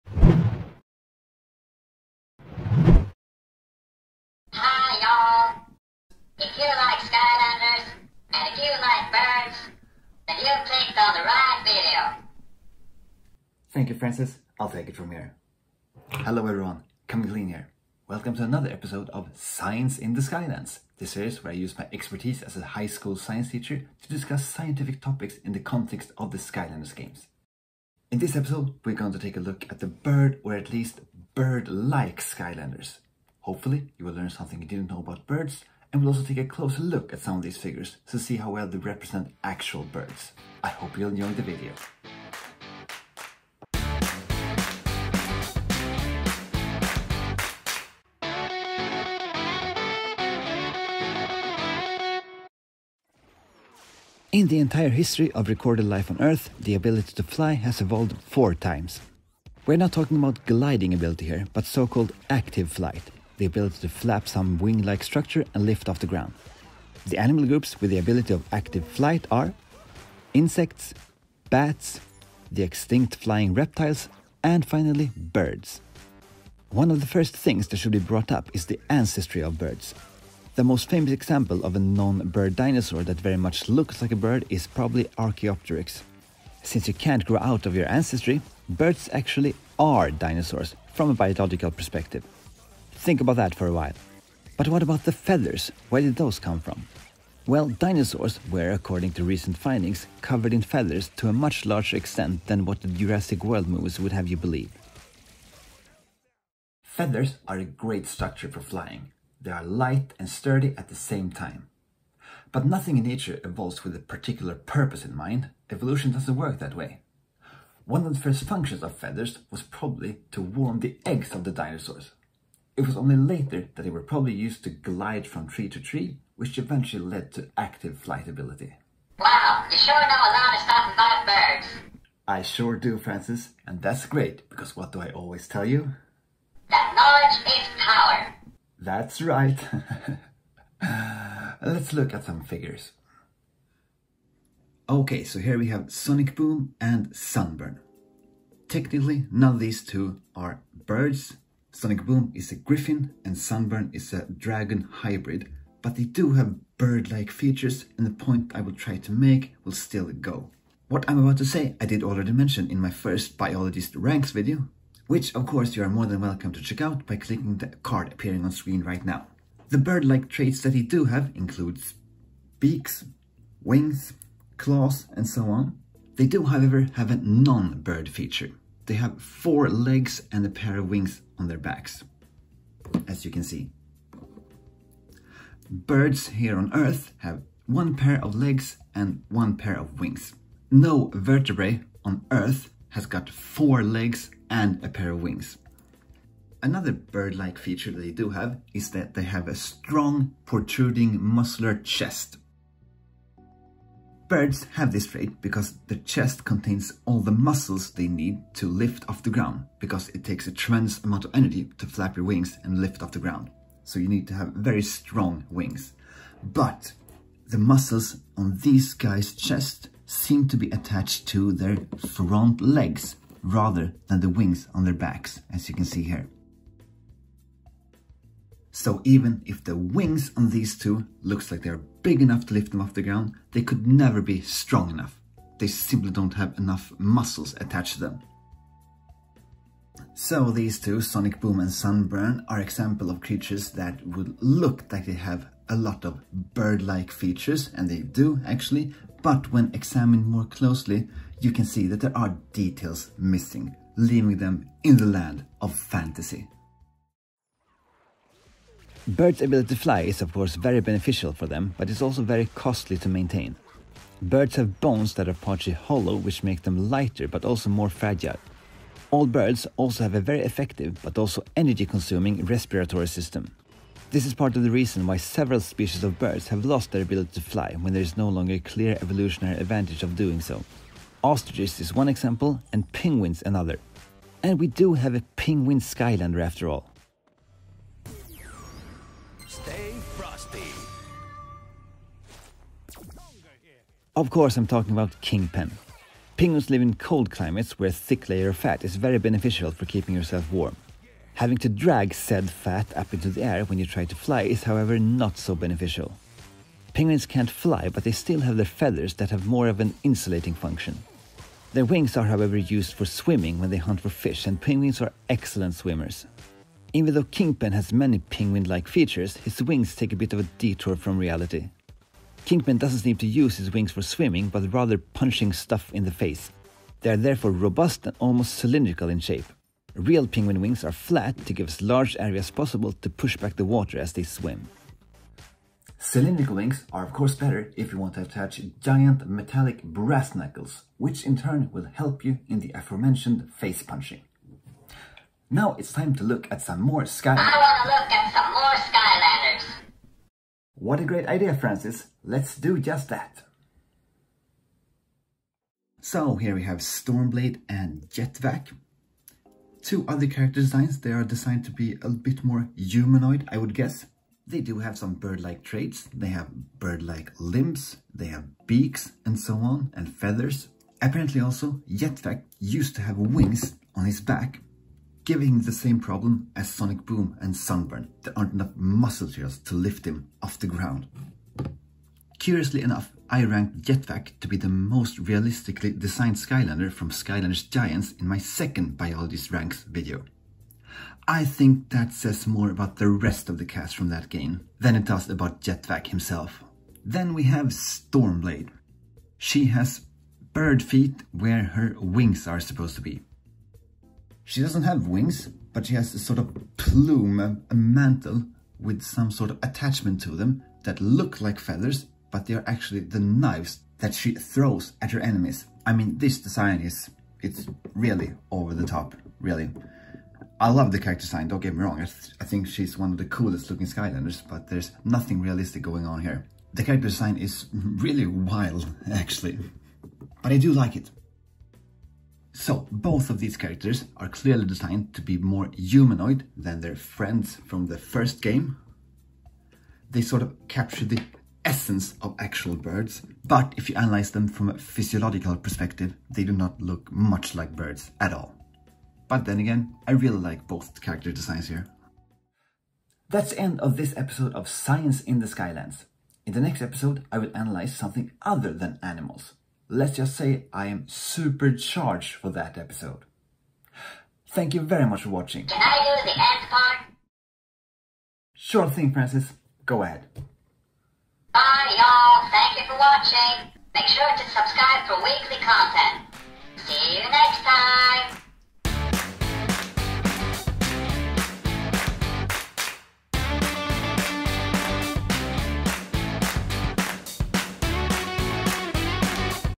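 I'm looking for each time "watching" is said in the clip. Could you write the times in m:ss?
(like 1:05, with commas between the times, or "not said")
7:45, 7:52.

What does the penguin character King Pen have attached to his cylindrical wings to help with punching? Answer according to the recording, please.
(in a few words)
Brass knuckles.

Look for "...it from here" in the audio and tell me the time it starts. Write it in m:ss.
0:14.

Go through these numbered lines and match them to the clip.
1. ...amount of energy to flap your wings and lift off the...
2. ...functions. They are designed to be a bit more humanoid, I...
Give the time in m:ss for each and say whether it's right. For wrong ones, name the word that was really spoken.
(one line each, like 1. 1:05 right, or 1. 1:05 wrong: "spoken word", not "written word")
1. 3:31 right
2. 6:00 wrong: "designs", not "functions".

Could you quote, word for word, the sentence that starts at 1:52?
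But nothing in nature evolves with a particular purpose in mind.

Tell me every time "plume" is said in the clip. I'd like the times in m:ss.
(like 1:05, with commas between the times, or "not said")
6:46.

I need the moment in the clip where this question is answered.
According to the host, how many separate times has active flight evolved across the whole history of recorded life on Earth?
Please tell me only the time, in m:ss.
0:58.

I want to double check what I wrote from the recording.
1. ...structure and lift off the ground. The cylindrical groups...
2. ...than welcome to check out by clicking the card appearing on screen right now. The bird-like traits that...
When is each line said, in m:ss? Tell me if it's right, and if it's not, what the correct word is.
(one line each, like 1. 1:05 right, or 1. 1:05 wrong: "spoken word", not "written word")
1. 1:05 wrong: "animal", not "cylindrical"
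2. 2:46 right.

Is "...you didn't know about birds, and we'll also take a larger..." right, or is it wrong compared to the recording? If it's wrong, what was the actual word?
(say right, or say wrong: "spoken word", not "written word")
wrong: "closer", not "larger".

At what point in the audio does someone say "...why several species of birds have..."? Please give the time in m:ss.
4:35.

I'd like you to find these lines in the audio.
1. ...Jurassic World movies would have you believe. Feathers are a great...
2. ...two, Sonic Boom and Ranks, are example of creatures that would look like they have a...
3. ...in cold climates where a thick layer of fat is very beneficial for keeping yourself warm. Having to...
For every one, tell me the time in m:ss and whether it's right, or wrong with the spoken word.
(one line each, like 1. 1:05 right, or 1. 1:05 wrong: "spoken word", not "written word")
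1. 1:42 right
2. 4:00 wrong: "Sunburn", not "Ranks"
3. 4:56 right.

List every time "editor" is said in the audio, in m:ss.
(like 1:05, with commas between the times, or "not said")
not said.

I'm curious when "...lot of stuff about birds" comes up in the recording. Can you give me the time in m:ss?
2:10.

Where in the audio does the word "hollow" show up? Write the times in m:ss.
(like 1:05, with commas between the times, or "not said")
4:25.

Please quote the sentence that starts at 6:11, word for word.
Apparently also, Jetvac used to have wings on his back, giving the same problem as Sonic Boom and Sunburn.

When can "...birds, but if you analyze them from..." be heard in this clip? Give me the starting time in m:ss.
7:22.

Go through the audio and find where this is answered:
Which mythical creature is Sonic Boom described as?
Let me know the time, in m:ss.
2:32.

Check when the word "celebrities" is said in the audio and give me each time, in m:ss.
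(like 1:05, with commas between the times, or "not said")
not said.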